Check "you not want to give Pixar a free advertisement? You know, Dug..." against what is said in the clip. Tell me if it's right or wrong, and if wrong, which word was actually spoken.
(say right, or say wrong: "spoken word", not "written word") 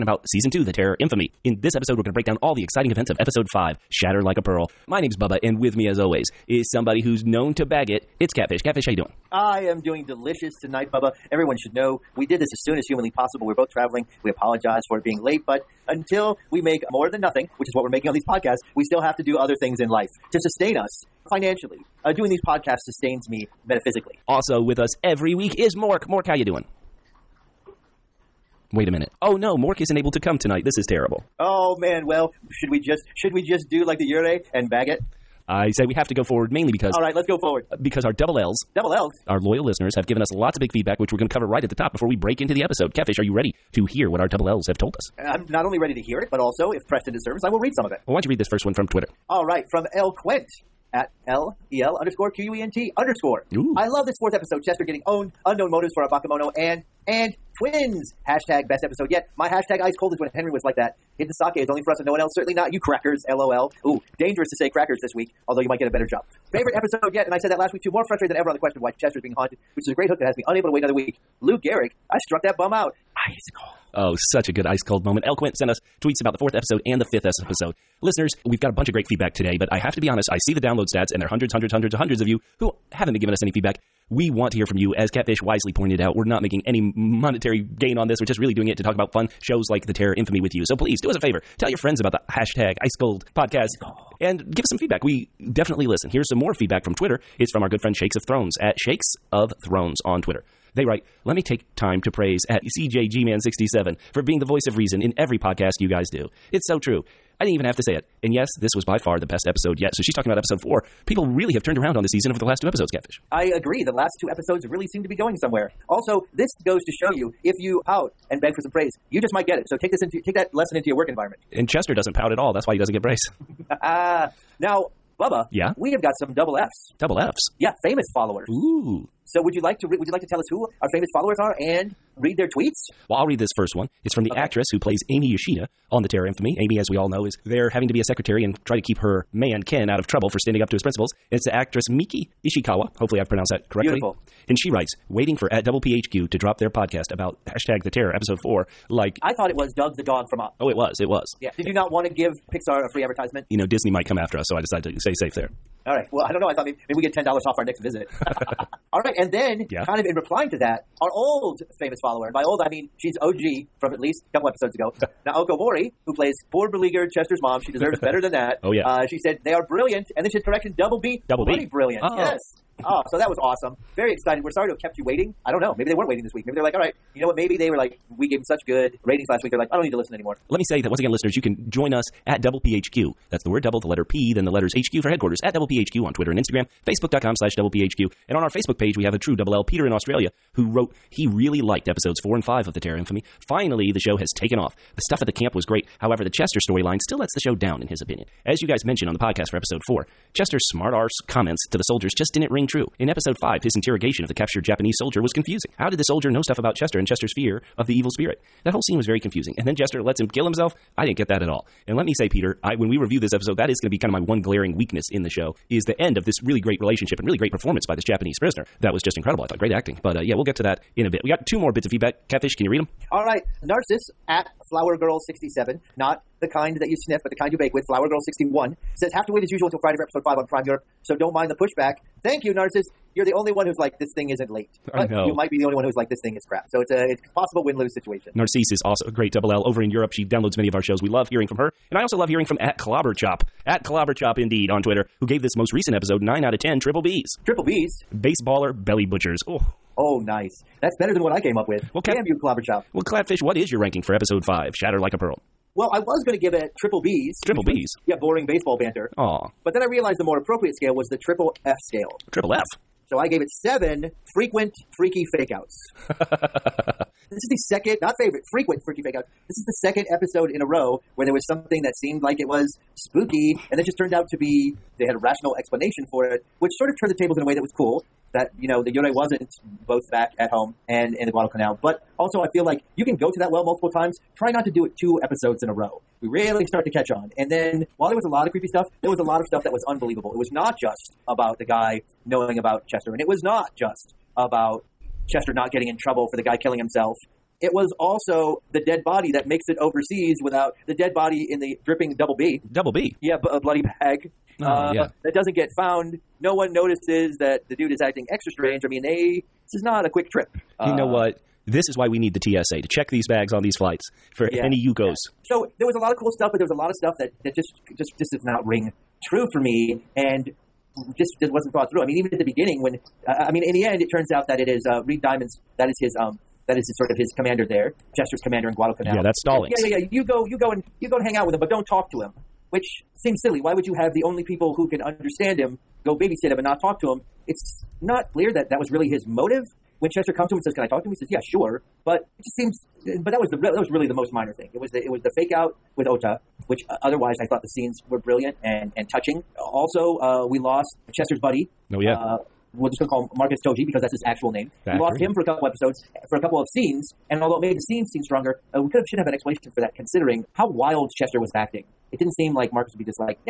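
wrong: "Disney", not "Dug".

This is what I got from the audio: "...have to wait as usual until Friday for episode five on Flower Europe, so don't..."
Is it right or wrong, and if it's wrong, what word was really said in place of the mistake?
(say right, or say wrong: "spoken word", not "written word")
wrong: "Prime", not "Flower".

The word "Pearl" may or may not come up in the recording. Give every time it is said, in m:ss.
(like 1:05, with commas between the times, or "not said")
0:04, 4:15.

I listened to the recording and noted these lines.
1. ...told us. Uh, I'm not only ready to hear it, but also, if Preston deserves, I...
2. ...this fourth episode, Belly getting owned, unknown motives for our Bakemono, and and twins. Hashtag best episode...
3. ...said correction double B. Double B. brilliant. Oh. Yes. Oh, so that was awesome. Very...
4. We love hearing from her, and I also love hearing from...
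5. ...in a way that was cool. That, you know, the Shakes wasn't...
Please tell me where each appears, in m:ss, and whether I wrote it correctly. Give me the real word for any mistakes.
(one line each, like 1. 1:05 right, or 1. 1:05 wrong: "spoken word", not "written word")
1. 0:44 right
2. 0:54 wrong: "Chester", not "Belly"
3. 2:50 right
4. 4:01 right
5. 4:37 wrong: "Yurei", not "Shakes".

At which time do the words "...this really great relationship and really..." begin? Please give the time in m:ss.
3:36.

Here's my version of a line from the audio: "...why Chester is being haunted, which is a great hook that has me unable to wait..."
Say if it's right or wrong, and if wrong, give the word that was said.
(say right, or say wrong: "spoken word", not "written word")
right.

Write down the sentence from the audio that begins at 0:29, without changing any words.
Oh no, Mork isn't able to come tonight.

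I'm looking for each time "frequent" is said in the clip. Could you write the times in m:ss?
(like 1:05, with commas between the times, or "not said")
4:24, 4:28.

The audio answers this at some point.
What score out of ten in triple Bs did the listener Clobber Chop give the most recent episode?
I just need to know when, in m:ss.
4:06.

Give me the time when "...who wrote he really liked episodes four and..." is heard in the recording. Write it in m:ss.
3:10.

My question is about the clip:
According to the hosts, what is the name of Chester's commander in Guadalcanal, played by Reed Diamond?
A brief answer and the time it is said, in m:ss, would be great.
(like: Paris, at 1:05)
Stallings, at 5:29.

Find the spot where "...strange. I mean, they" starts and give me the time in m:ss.
5:08.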